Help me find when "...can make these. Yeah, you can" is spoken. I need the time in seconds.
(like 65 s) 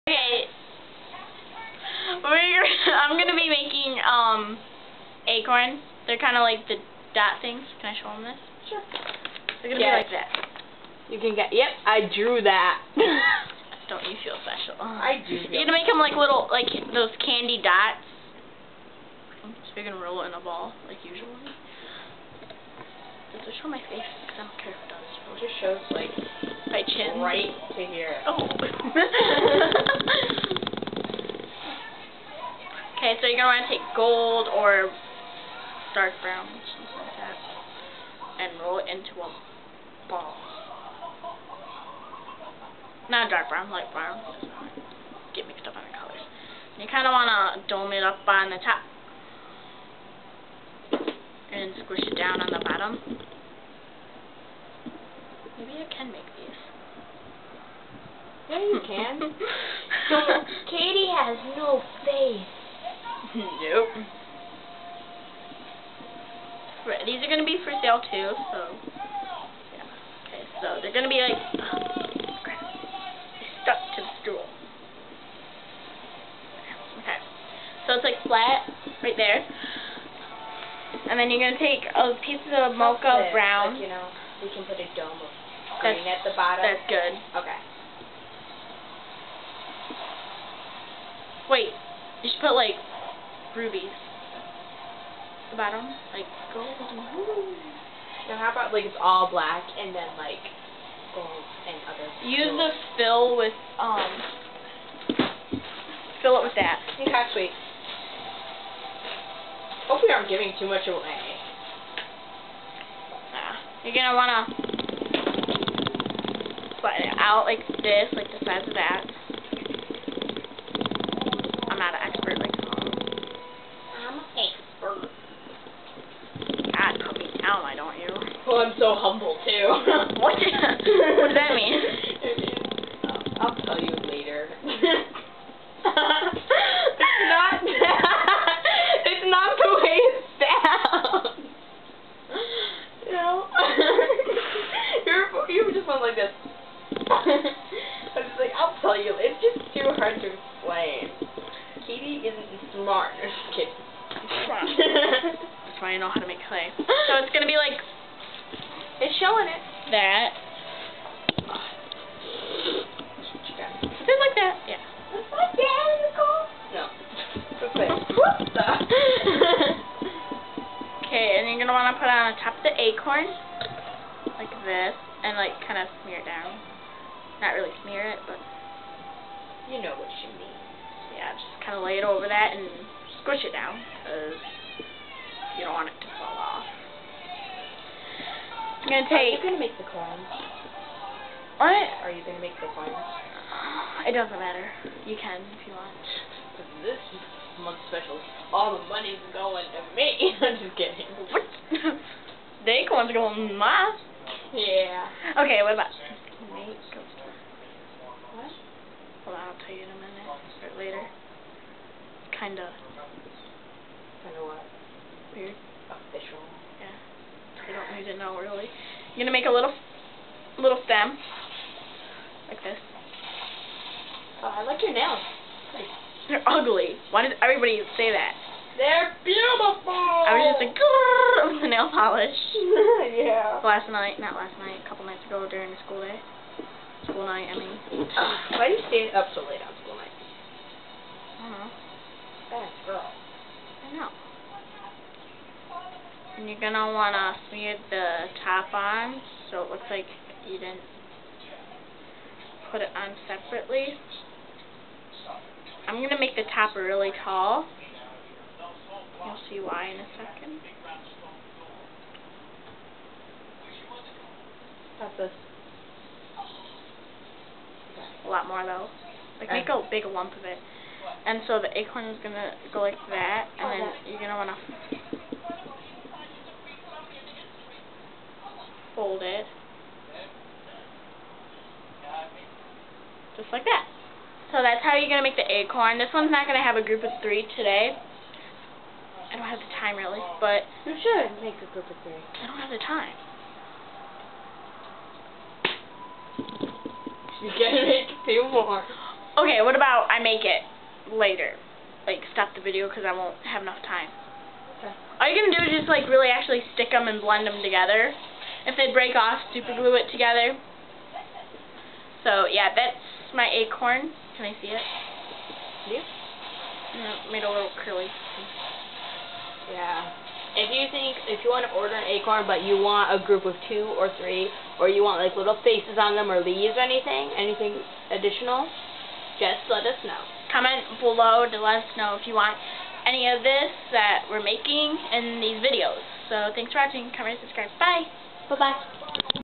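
55 s.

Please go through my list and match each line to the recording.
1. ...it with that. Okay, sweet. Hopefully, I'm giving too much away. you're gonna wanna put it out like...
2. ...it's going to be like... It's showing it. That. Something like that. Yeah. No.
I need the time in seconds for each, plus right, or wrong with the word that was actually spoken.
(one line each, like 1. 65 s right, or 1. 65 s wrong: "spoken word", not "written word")
1. 106 s right
2. 157 s right.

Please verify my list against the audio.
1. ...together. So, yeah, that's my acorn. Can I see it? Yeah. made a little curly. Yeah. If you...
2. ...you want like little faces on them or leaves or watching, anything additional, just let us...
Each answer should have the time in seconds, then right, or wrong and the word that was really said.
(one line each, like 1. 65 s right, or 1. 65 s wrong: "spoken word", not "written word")
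1. 310 s right
2. 324 s wrong: "anything", not "watching".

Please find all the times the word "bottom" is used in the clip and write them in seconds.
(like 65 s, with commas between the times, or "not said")
52 s, 86 s, 95 s.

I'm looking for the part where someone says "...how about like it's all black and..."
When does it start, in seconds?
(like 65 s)
98 s.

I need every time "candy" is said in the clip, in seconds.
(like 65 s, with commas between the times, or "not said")
17 s.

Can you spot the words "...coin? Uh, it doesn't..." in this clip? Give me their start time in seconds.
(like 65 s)
192 s.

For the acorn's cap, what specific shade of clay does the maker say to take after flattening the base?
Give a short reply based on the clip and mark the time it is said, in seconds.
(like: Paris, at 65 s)
mocha brown, at 82 s.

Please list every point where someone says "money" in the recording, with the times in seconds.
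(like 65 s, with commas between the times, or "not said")
198 s.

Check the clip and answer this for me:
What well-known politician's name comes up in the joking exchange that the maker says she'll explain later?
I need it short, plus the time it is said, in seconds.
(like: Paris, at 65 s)
Obama, at 127 s.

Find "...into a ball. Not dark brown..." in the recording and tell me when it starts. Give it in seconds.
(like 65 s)
38 s.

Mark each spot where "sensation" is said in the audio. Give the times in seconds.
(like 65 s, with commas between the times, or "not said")
not said.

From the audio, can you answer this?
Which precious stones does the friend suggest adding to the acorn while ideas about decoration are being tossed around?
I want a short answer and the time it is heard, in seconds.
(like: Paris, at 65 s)
rubies, at 93 s.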